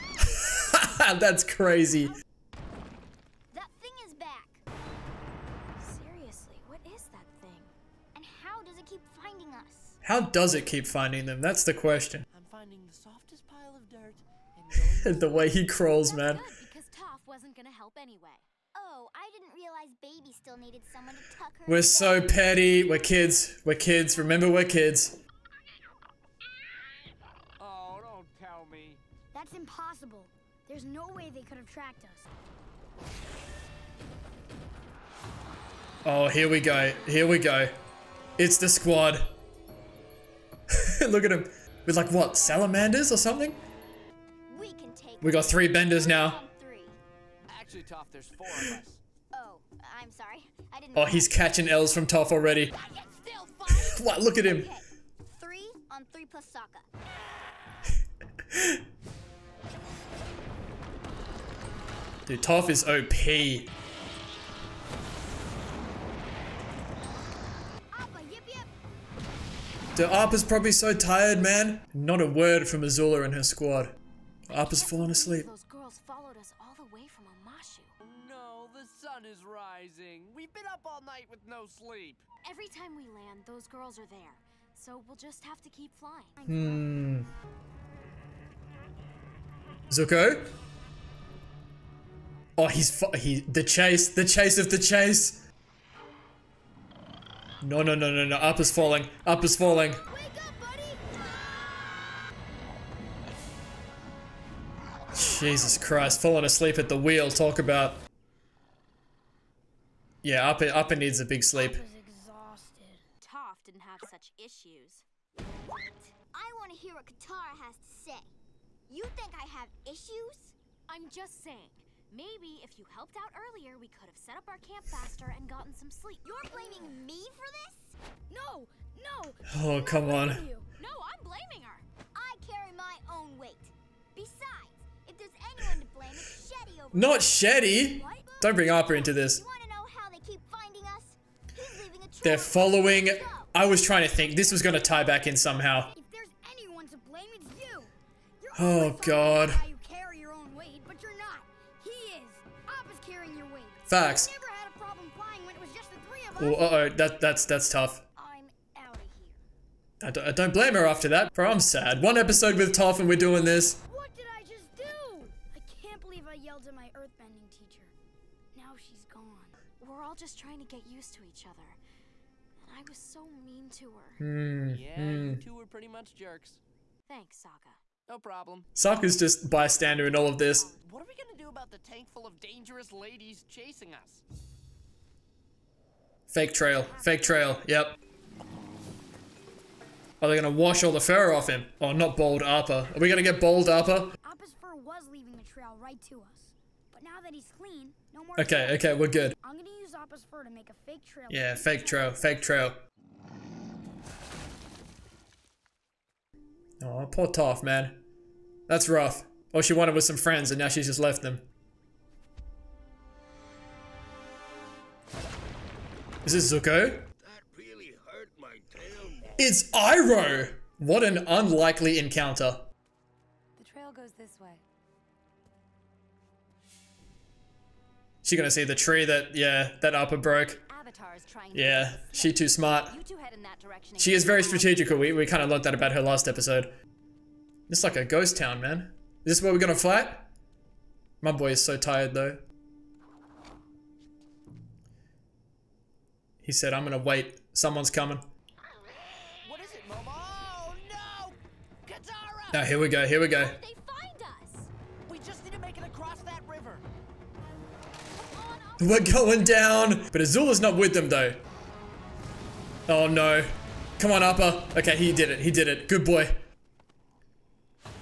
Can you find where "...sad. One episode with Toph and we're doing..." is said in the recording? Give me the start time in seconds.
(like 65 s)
161 s.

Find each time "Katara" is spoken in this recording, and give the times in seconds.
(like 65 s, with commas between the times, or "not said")
117 s, 251 s.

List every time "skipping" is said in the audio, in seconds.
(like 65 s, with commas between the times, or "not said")
not said.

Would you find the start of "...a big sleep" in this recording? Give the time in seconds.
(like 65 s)
111 s.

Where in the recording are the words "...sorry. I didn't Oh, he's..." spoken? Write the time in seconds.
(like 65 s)
50 s.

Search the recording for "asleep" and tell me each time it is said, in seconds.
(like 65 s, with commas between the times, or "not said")
75 s, 106 s.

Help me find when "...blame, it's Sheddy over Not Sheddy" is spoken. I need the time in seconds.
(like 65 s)
135 s.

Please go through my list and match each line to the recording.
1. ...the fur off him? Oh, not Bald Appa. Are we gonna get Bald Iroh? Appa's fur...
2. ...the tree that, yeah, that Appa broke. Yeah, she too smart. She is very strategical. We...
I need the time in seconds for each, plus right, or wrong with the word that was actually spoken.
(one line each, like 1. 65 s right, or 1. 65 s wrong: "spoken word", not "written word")
1. 190 s wrong: "Appa", not "Iroh"
2. 228 s right.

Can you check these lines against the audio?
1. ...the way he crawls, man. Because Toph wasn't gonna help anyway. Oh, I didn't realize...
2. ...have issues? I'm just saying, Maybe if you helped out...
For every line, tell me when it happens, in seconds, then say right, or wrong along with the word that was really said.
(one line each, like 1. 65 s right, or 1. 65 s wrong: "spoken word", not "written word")
1. 15 s right
2. 119 s right.